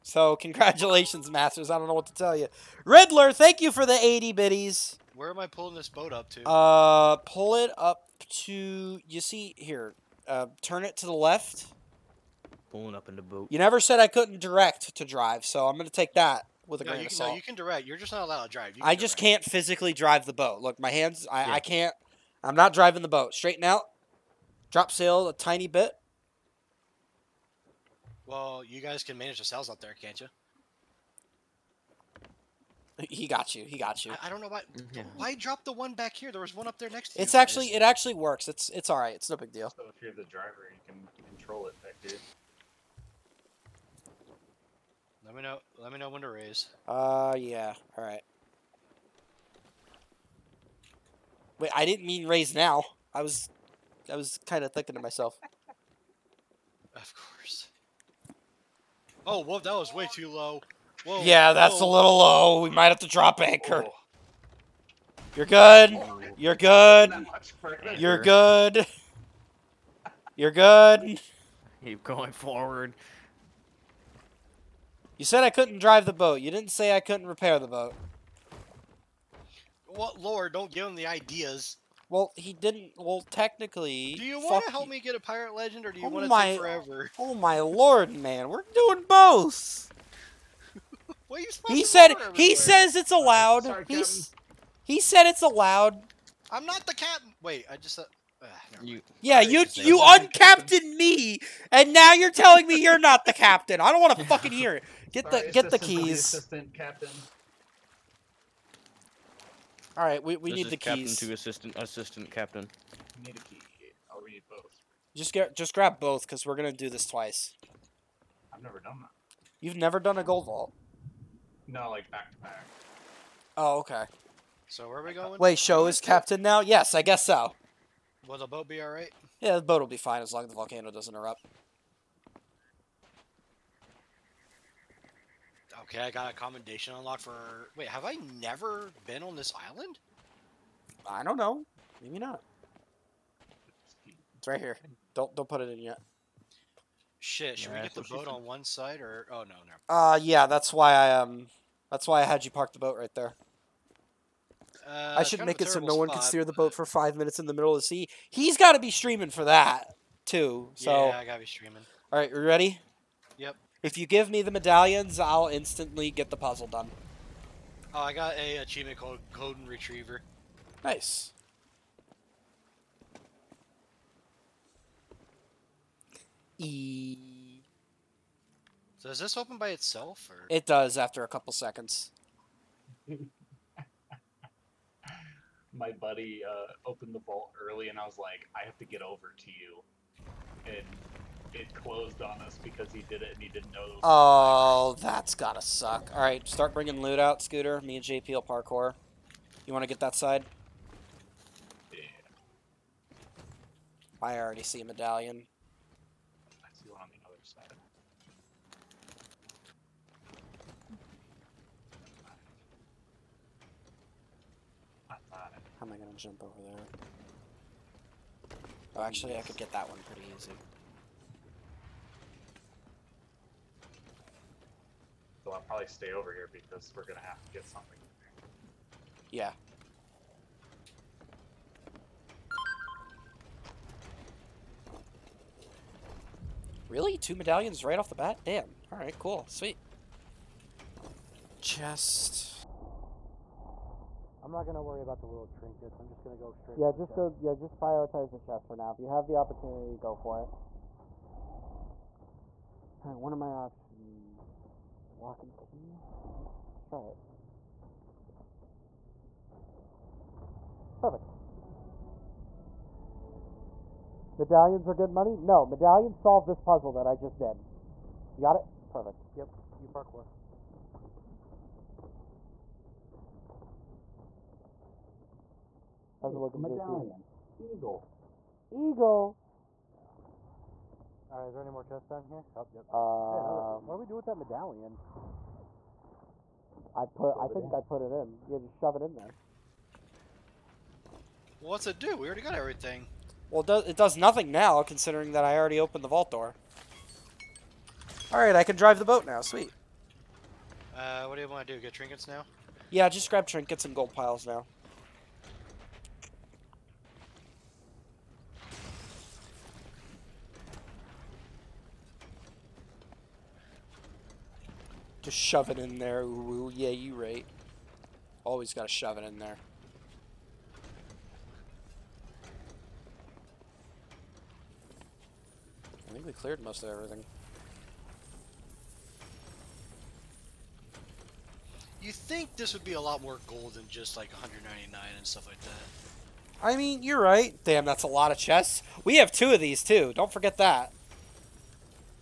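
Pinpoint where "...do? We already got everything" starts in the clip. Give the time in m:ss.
4:51.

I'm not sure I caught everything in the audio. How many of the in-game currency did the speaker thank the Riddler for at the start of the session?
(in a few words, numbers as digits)
80.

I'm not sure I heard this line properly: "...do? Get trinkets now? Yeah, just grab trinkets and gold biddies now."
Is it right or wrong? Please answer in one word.
wrong.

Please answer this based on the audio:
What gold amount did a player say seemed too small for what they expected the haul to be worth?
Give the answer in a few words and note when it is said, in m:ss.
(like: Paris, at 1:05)
199, at 5:34.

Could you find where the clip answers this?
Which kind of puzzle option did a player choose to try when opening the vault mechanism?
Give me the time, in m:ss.
4:15.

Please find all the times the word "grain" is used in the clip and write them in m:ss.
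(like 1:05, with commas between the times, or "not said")
0:16.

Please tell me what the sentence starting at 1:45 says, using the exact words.
Get sorry, the get the keys.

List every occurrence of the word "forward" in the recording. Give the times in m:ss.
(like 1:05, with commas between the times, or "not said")
1:12.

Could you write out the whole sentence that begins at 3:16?
All right, start bringing loot out, Scooter.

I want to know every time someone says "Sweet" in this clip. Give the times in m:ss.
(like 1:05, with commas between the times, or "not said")
3:59, 4:59.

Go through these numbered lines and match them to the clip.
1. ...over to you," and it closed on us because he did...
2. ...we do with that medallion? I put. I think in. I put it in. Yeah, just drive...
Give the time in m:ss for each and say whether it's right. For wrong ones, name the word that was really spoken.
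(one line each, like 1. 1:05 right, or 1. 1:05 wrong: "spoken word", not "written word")
1. 3:09 right
2. 4:43 wrong: "shove", not "drive".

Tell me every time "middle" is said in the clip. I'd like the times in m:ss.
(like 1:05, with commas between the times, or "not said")
2:37.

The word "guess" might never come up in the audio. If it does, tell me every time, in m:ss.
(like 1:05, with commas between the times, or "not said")
2:07.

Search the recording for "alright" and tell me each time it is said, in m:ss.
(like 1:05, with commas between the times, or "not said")
2:08, 3:58.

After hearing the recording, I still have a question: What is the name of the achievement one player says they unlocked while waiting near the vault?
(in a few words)
Golden Retriever.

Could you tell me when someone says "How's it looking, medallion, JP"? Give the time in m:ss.
4:36.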